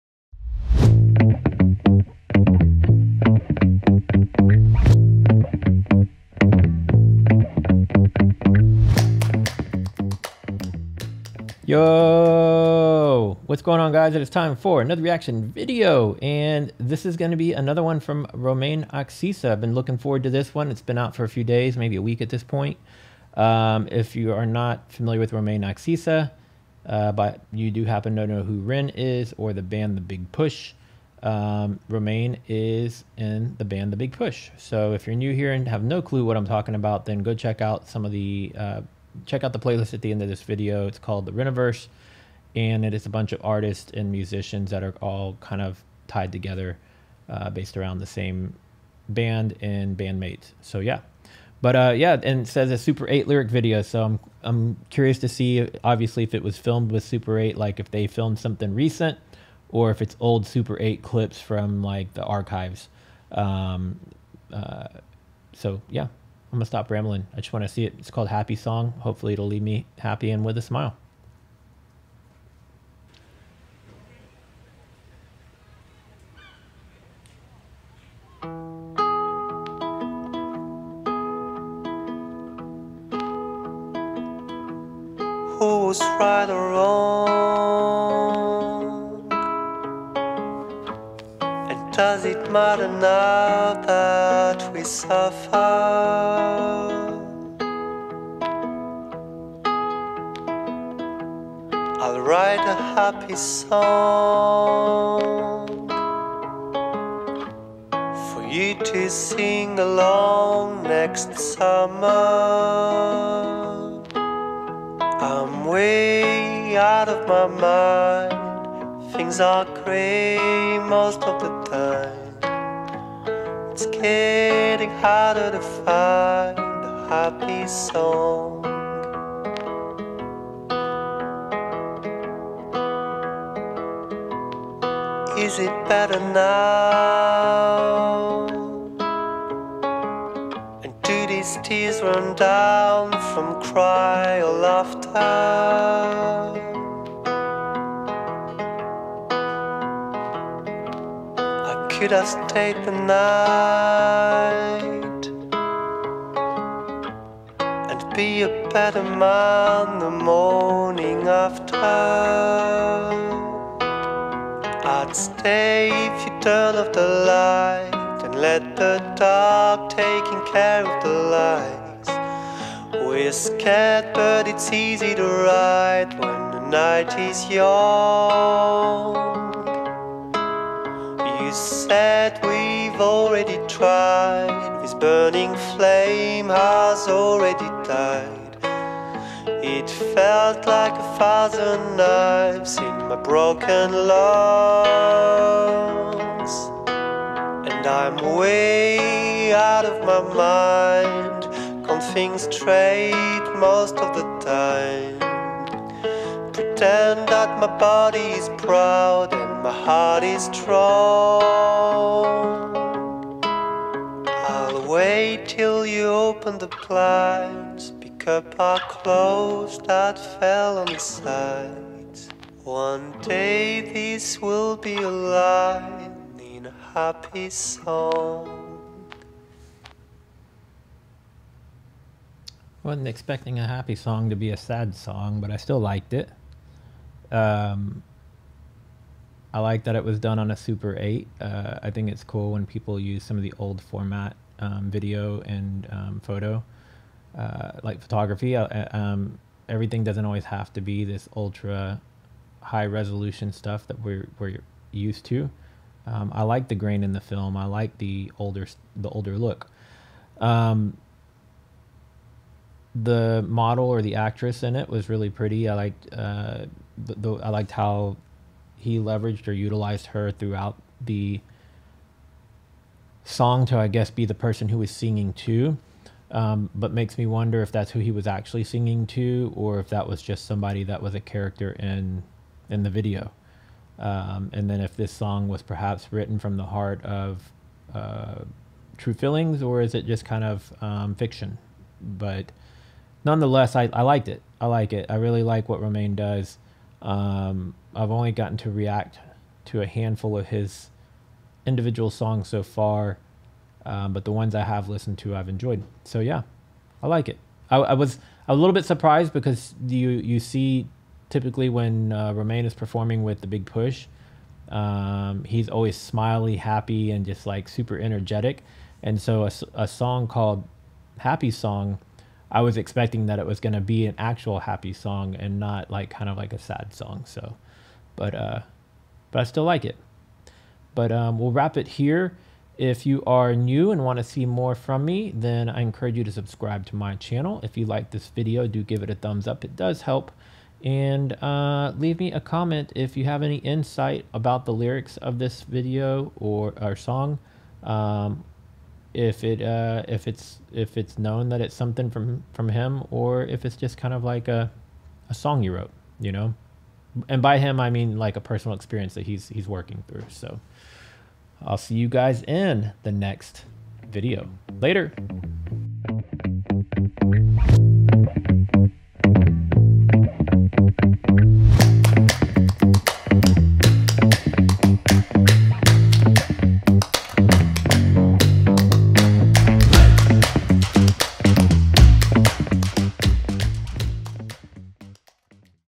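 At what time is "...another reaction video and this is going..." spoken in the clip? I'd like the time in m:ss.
0:14.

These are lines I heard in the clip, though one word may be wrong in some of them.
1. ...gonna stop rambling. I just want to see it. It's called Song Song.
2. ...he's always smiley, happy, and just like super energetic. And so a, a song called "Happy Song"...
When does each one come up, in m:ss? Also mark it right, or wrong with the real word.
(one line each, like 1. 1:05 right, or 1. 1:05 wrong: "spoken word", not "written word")
1. 1:06 wrong: "Happy", not "Song"
2. 5:15 right.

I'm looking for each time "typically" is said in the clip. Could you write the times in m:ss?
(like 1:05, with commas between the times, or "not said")
5:11.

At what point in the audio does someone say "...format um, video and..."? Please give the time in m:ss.
4:03.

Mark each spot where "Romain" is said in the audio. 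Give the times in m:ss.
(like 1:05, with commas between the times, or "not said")
0:18, 0:25, 0:31, 4:55, 5:12.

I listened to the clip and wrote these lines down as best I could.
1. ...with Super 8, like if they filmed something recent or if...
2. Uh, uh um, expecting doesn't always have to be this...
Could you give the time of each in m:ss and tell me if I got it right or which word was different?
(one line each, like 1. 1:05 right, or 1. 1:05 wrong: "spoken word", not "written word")
1. 0:56 right
2. 4:08 wrong: "everything", not "expecting".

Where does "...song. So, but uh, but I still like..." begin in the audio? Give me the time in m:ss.
5:26.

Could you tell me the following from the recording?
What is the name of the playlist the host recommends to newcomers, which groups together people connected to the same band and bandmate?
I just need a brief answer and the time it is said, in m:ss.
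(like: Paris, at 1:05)
The Reniverse, at 0:41.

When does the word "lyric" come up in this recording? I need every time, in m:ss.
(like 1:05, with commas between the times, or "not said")
0:53, 5:44.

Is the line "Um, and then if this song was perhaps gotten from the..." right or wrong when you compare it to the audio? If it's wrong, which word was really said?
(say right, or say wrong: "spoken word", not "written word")
wrong: "written", not "gotten".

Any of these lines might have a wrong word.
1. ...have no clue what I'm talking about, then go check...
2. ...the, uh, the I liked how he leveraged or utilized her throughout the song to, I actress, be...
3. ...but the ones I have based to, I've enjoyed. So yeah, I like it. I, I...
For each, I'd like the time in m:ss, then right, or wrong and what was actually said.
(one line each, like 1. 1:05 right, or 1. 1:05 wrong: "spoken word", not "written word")
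1. 0:35 right
2. 4:26 wrong: "guess", not "actress"
3. 5:04 wrong: "listened", not "based".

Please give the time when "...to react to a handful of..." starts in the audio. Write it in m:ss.
4:58.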